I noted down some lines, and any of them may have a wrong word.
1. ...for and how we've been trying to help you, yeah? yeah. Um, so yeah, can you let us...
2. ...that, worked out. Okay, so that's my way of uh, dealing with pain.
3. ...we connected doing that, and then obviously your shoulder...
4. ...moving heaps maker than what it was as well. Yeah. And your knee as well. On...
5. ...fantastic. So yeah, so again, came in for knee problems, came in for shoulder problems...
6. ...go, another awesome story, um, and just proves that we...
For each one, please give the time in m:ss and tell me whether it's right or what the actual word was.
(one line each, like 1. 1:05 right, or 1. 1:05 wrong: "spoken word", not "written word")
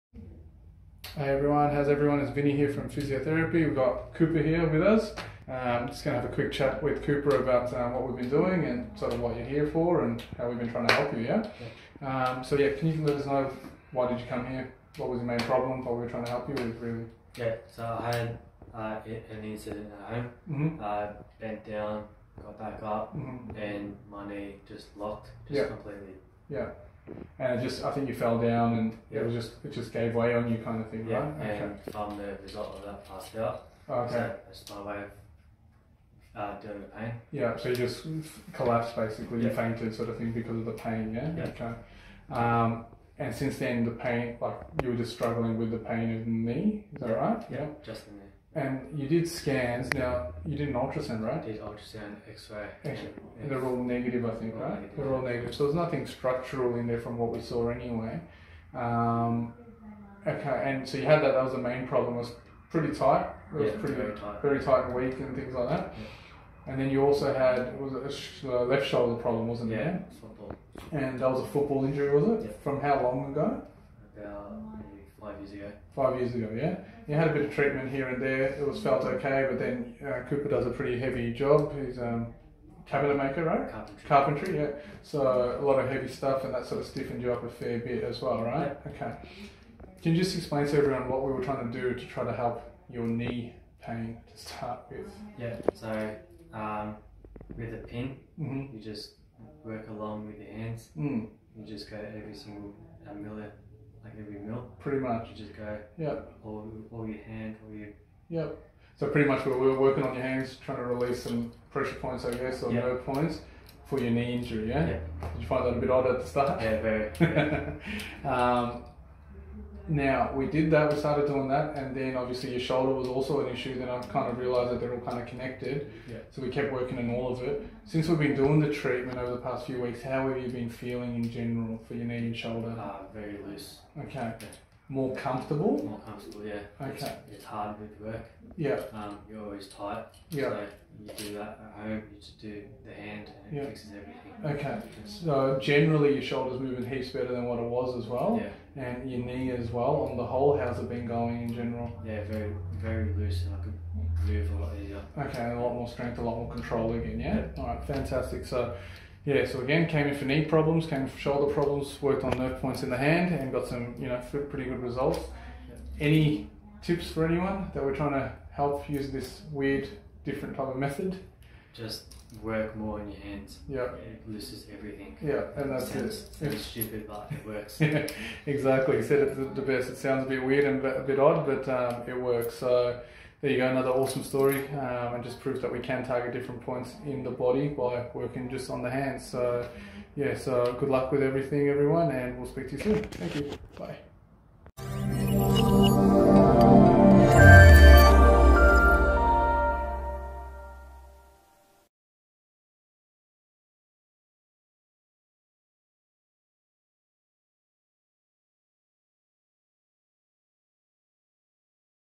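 1. 0:09 right
2. 0:32 wrong: "passed", not "worked"
3. 2:00 wrong: "started", not "connected"
4. 2:26 wrong: "better", not "maker"
5. 2:37 right
6. 3:03 right.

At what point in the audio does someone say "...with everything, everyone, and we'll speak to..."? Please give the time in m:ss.
3:11.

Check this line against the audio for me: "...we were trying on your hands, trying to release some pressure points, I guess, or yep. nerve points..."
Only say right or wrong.
wrong.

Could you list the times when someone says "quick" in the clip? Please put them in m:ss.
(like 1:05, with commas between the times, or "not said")
0:06.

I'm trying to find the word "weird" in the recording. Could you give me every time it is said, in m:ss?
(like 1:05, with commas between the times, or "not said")
2:49, 3:00.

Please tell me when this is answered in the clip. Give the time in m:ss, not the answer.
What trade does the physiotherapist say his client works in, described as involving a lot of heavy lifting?
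1:22.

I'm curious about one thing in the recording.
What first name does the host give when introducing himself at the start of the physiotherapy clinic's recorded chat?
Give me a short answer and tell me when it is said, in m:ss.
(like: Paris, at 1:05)
Vinny, at 0:02.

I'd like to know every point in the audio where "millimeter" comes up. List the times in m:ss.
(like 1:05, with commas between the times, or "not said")
1:43.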